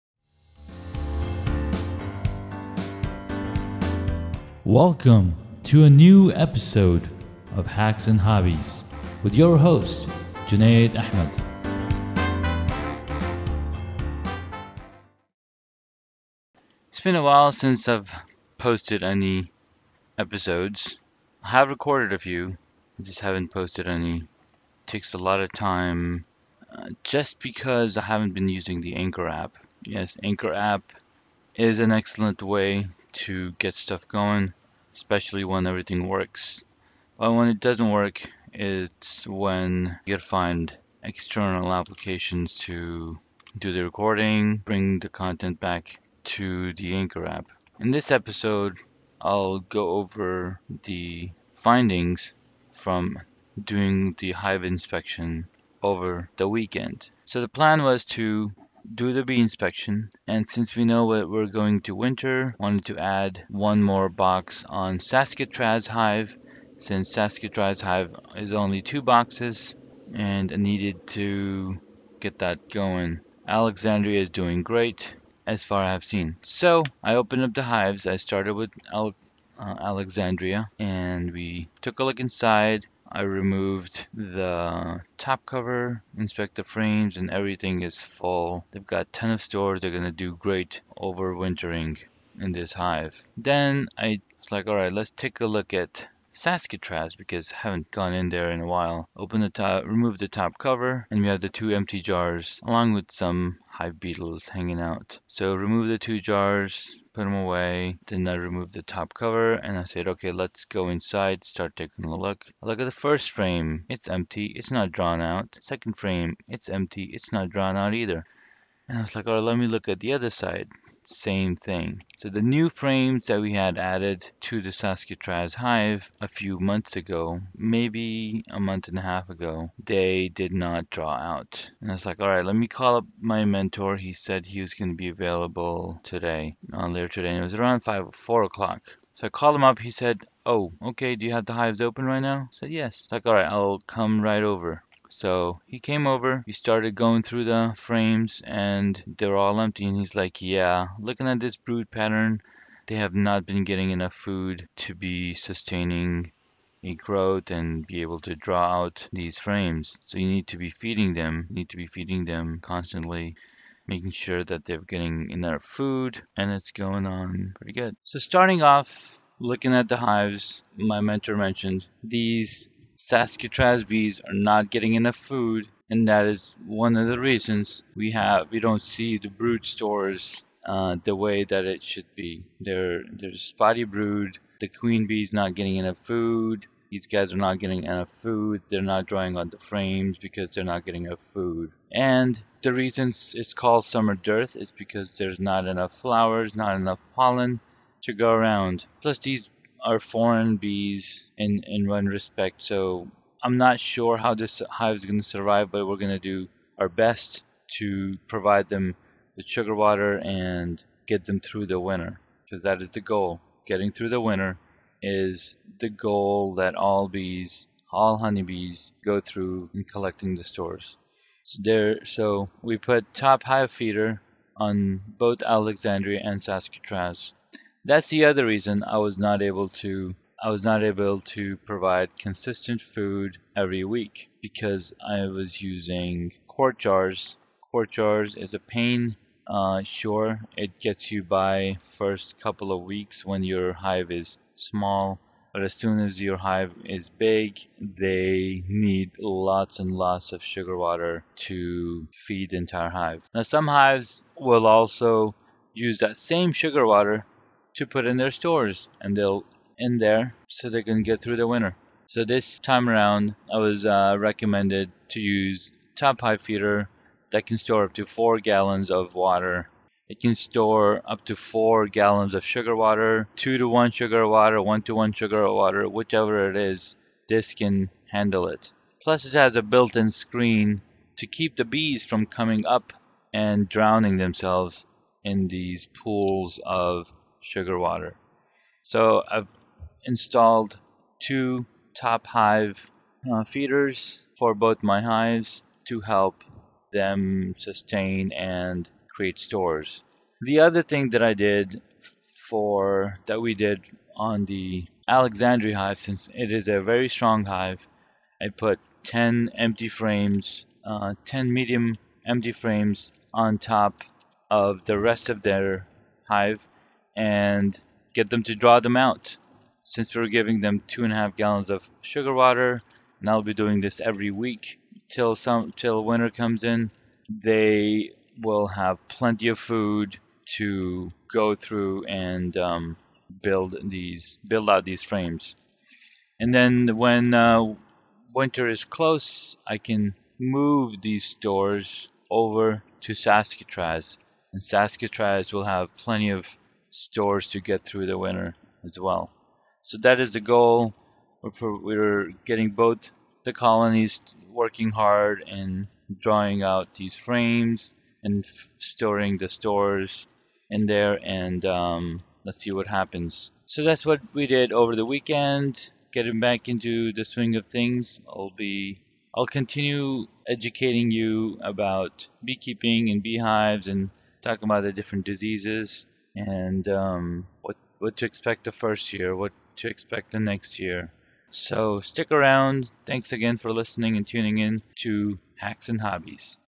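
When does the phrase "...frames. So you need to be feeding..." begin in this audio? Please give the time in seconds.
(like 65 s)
159 s.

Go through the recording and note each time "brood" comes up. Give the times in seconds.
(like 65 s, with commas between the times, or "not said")
151 s, 179 s, 183 s.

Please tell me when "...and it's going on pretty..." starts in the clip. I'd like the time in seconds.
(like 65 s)
166 s.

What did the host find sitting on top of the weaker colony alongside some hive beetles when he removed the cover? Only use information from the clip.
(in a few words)
two empty jars.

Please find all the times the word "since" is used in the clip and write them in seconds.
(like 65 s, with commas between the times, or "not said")
17 s, 60 s, 66 s, 305 s, 319 s.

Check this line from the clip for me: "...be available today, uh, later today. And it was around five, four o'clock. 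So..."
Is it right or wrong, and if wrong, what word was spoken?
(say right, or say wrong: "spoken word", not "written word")
right.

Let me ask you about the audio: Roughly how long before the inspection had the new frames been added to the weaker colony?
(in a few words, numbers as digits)
a month and a half.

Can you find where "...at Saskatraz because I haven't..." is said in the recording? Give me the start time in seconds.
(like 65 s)
95 s.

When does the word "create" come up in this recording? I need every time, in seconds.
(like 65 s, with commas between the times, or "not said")
299 s.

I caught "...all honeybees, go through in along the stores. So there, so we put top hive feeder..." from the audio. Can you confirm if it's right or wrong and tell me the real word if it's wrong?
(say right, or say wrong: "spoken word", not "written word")
wrong: "collecting", not "along".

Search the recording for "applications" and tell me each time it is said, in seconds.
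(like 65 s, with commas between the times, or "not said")
41 s.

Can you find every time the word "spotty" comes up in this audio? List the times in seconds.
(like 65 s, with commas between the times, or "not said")
183 s.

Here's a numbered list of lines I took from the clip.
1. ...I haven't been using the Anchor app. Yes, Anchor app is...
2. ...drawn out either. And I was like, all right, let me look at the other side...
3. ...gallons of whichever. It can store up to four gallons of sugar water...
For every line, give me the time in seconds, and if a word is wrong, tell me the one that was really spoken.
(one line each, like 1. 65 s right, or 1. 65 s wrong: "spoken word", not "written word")
1. 27 s right
2. 117 s right
3. 268 s wrong: "water", not "whichever".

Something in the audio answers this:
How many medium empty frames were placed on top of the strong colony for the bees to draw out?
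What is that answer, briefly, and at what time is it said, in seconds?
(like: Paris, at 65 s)
10, at 311 s.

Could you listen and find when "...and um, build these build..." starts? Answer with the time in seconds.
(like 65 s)
332 s.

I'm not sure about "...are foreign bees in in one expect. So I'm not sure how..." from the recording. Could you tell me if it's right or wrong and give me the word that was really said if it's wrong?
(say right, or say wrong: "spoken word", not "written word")
wrong: "respect", not "expect".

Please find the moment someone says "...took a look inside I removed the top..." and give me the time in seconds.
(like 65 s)
81 s.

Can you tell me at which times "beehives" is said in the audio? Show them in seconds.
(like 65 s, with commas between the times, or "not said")
373 s.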